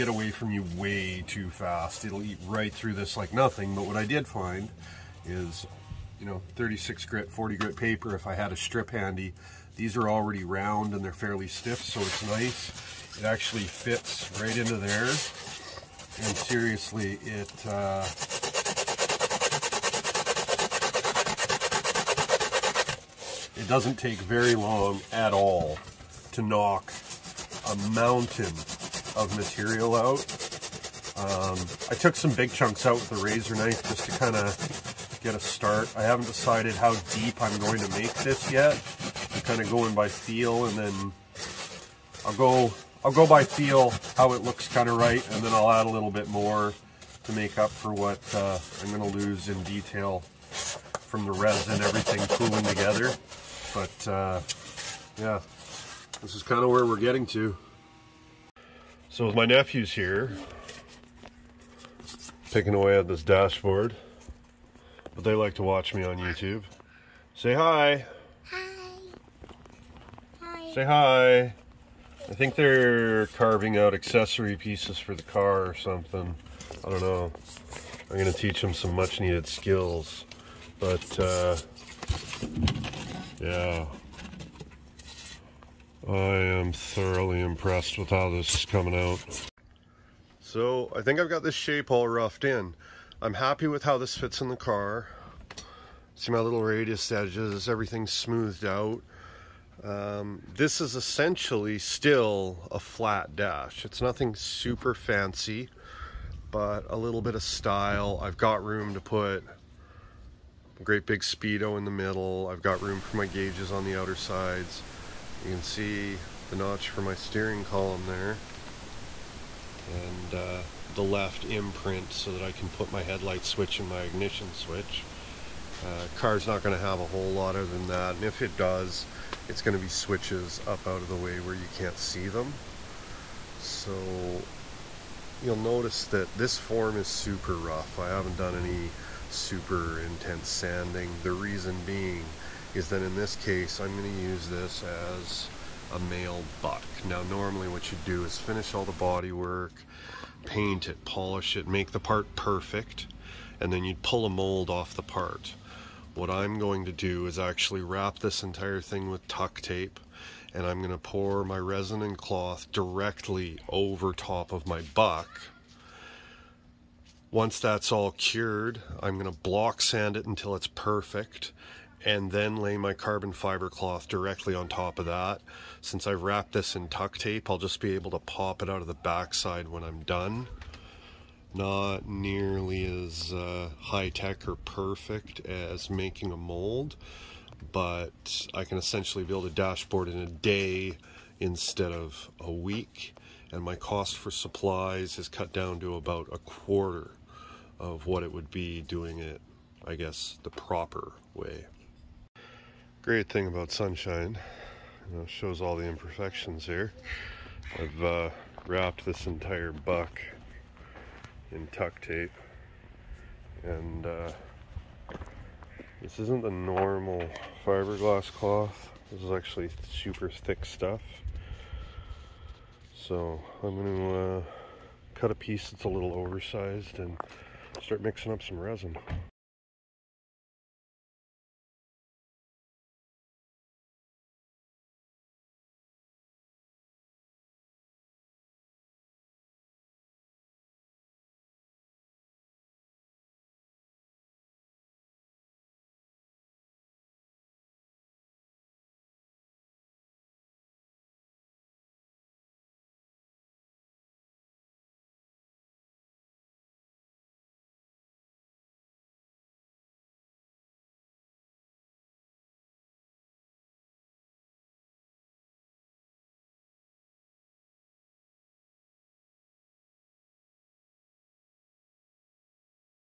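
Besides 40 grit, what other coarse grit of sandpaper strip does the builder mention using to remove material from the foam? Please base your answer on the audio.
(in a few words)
36 grit.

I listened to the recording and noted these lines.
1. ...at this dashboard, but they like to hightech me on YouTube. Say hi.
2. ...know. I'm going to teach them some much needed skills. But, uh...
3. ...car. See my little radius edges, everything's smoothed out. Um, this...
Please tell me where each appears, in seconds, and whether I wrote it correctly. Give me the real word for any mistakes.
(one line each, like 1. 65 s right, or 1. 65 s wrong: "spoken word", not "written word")
1. 62 s wrong: "watch", not "hightech"
2. 77 s right
3. 94 s right.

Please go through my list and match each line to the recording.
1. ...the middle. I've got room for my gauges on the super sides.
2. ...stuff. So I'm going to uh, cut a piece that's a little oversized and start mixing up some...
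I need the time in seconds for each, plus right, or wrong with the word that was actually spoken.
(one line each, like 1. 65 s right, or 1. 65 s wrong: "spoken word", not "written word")
1. 111 s wrong: "outer", not "super"
2. 220 s right.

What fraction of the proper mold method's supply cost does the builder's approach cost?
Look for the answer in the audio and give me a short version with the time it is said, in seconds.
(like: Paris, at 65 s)
a quarter, at 196 s.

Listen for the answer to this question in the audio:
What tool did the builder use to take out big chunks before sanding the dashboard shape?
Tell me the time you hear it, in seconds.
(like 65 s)
33 s.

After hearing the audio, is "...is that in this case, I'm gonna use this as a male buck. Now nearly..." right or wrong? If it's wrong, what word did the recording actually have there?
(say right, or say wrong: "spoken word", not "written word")
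wrong: "normally", not "nearly".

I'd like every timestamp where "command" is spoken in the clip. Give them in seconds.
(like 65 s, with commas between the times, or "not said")
not said.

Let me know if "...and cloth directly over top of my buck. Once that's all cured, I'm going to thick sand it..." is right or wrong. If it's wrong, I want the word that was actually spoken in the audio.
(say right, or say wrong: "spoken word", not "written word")
wrong: "block", not "thick".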